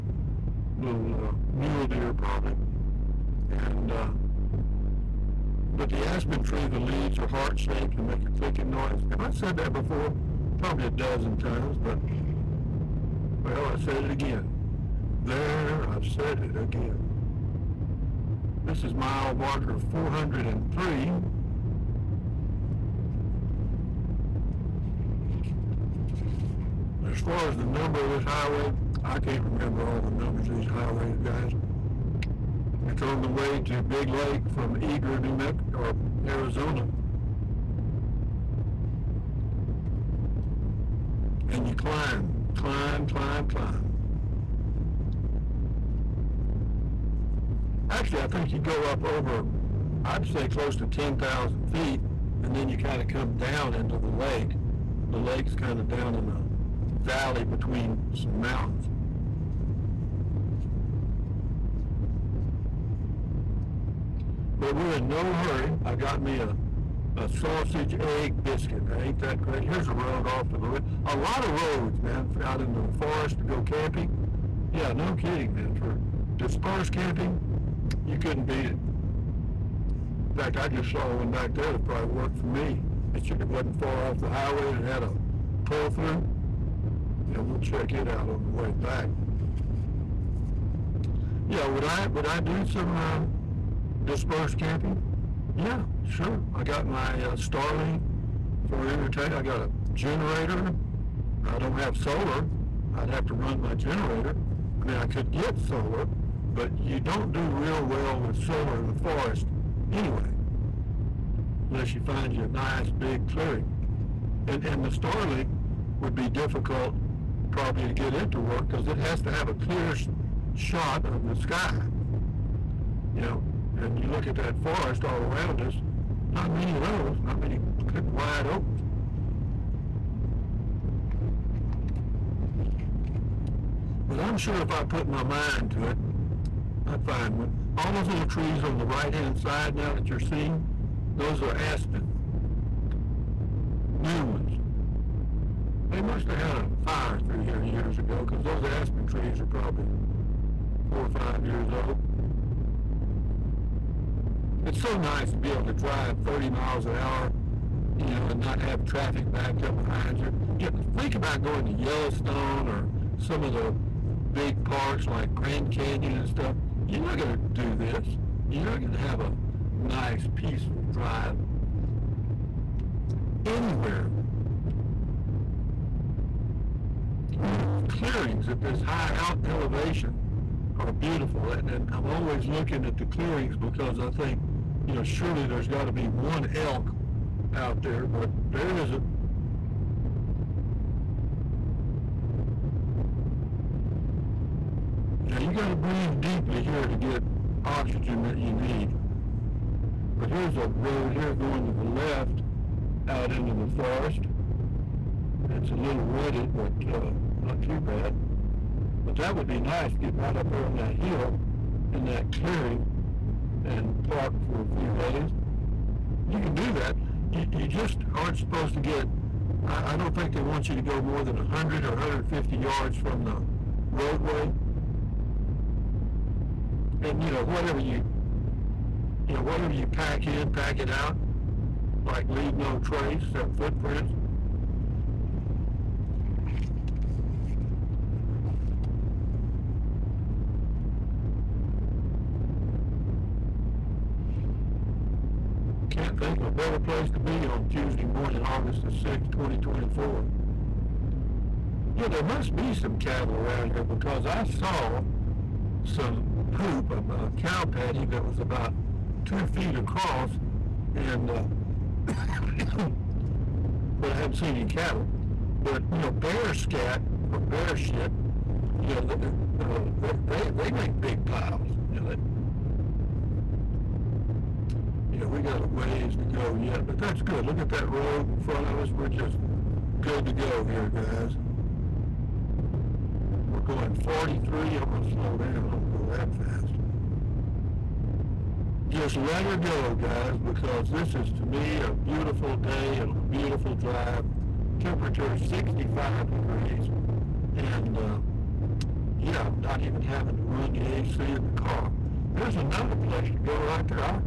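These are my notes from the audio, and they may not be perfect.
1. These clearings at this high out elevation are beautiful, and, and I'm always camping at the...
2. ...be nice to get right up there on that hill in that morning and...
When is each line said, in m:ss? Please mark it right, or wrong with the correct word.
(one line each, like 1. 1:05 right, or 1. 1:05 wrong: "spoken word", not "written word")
1. 2:57 wrong: "looking", not "camping"
2. 3:29 wrong: "clearing", not "morning".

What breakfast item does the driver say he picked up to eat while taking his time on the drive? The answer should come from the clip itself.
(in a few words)
sausage egg biscuit.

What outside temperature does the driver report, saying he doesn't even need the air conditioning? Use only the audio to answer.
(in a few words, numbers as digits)
65 degrees.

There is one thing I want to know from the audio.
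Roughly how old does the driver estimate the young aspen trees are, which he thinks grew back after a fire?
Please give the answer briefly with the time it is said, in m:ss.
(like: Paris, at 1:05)
4 or 5 years, at 2:30.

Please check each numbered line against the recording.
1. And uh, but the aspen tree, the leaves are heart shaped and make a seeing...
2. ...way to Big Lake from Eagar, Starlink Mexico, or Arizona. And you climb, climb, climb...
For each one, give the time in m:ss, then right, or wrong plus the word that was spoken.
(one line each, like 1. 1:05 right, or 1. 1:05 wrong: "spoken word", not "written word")
1. 0:03 wrong: "clicking", not "seeing"
2. 0:33 wrong: "New", not "Starlink".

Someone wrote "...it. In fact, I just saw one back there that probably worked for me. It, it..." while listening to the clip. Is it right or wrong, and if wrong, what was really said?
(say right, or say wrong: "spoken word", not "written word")
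right.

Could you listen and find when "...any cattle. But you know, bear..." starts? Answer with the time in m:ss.
4:24.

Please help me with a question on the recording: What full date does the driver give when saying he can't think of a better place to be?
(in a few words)
August 6, 2024.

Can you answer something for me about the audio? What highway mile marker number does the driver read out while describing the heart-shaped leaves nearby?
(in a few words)
403.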